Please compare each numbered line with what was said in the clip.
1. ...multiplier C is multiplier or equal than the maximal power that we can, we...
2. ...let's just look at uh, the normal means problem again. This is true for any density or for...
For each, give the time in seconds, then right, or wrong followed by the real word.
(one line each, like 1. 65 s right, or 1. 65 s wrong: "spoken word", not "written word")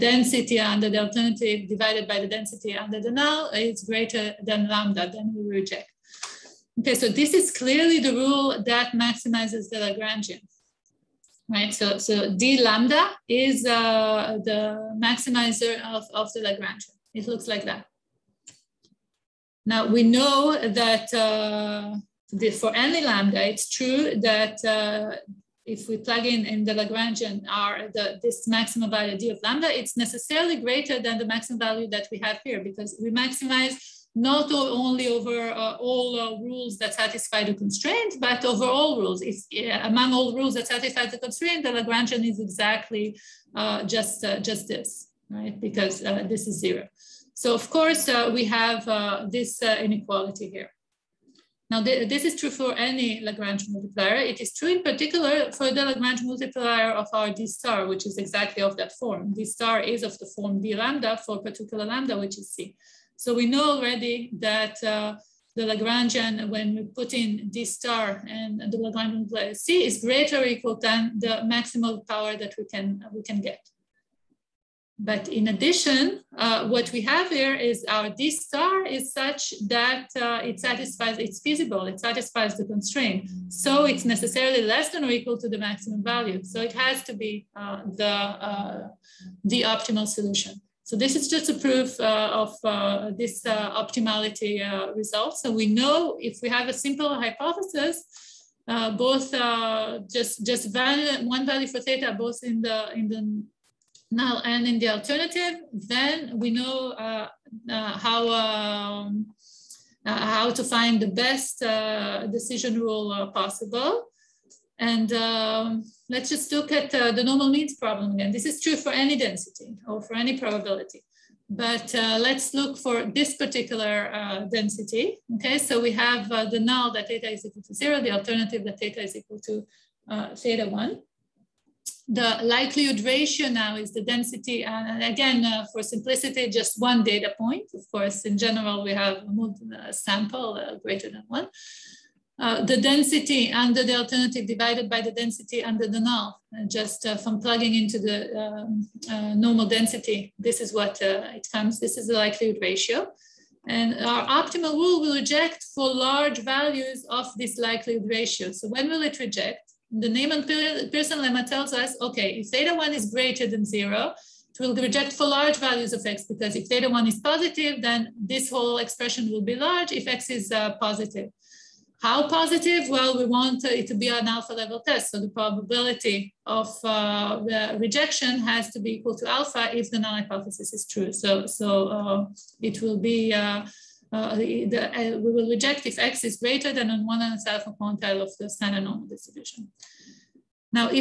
1. 69 s wrong: "greater", not "multiplier"
2. 116 s right.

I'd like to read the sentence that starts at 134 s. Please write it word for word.
And again, uh, for simplicity, just one data point.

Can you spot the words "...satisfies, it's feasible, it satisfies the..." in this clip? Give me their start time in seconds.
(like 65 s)
80 s.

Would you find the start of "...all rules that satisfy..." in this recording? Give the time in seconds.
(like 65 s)
40 s.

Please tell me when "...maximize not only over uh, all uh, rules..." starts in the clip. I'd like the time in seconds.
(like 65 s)
33 s.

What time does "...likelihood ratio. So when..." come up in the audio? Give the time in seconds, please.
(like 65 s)
157 s.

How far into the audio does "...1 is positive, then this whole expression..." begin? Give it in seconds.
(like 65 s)
166 s.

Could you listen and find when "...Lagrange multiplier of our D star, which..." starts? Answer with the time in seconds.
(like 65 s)
55 s.